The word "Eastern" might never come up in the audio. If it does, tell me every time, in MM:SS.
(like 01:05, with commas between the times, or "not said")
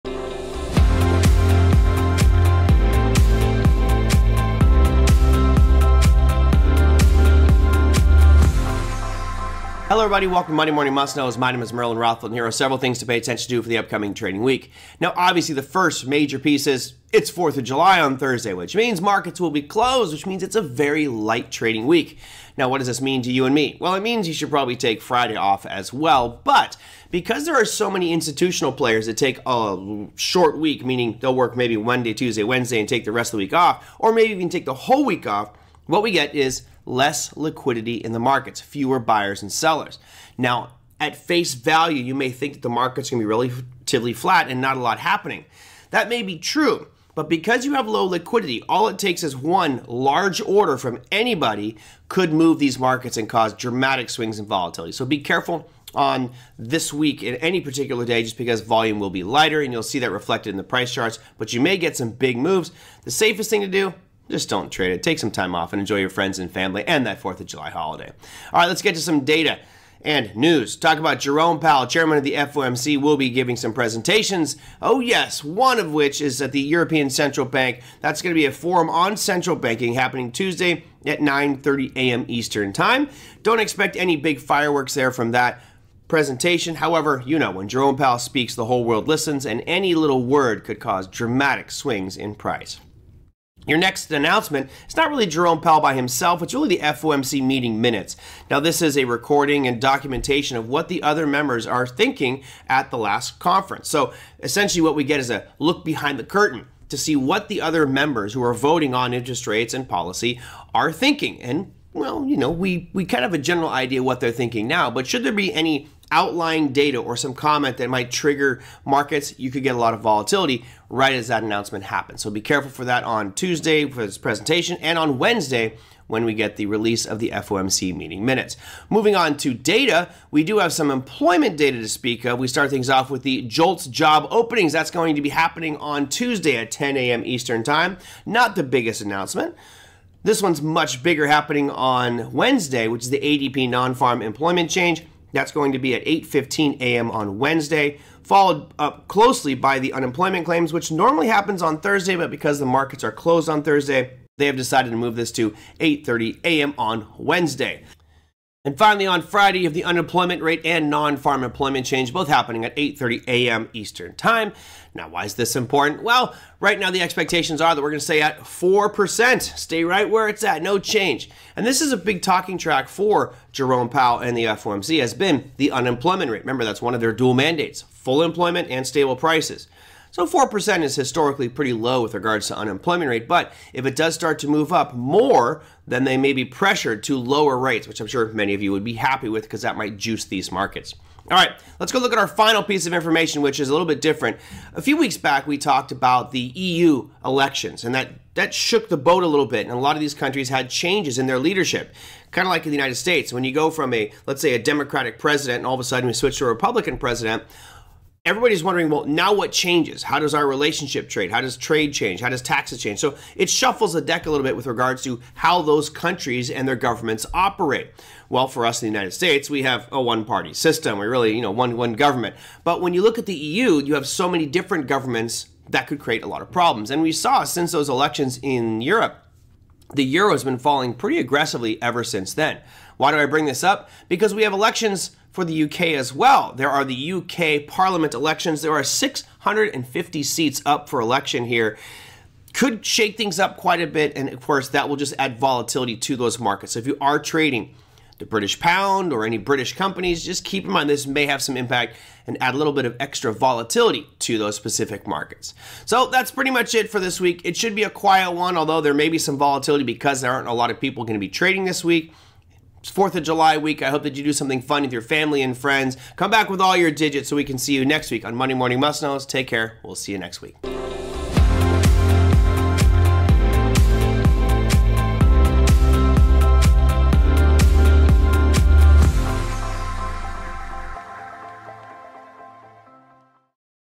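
01:22, 02:17, 02:43.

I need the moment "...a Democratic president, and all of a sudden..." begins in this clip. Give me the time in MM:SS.
03:24.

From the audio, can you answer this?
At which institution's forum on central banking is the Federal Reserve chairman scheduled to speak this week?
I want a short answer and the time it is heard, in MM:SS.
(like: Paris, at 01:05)
European Central Bank, at 01:16.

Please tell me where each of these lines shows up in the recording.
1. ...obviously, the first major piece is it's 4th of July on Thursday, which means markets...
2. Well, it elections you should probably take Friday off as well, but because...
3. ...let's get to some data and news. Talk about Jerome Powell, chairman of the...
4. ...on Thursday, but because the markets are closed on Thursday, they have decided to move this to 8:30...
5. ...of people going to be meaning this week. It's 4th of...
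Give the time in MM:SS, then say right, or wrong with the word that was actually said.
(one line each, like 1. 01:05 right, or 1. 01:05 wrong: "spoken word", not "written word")
1. 00:15 right
2. 00:23 wrong: "means", not "elections"
3. 01:08 right
4. 02:31 right
5. 04:20 wrong: "trading", not "meaning".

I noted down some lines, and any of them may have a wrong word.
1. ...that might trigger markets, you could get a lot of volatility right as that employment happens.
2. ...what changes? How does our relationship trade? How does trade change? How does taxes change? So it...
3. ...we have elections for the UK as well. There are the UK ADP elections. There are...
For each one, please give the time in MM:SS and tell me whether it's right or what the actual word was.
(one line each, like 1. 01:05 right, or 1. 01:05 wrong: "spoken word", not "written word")
1. 01:57 wrong: "announcement", not "employment"
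2. 03:29 right
3. 03:54 wrong: "Parliament", not "ADP".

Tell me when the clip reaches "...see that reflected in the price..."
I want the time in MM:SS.
00:59.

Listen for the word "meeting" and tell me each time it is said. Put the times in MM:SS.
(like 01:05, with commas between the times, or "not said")
01:37, 02:07.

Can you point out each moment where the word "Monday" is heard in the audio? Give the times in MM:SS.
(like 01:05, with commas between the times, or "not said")
00:10, 00:31, 04:28.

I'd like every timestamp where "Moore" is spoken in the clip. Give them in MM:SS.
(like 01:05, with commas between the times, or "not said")
not said.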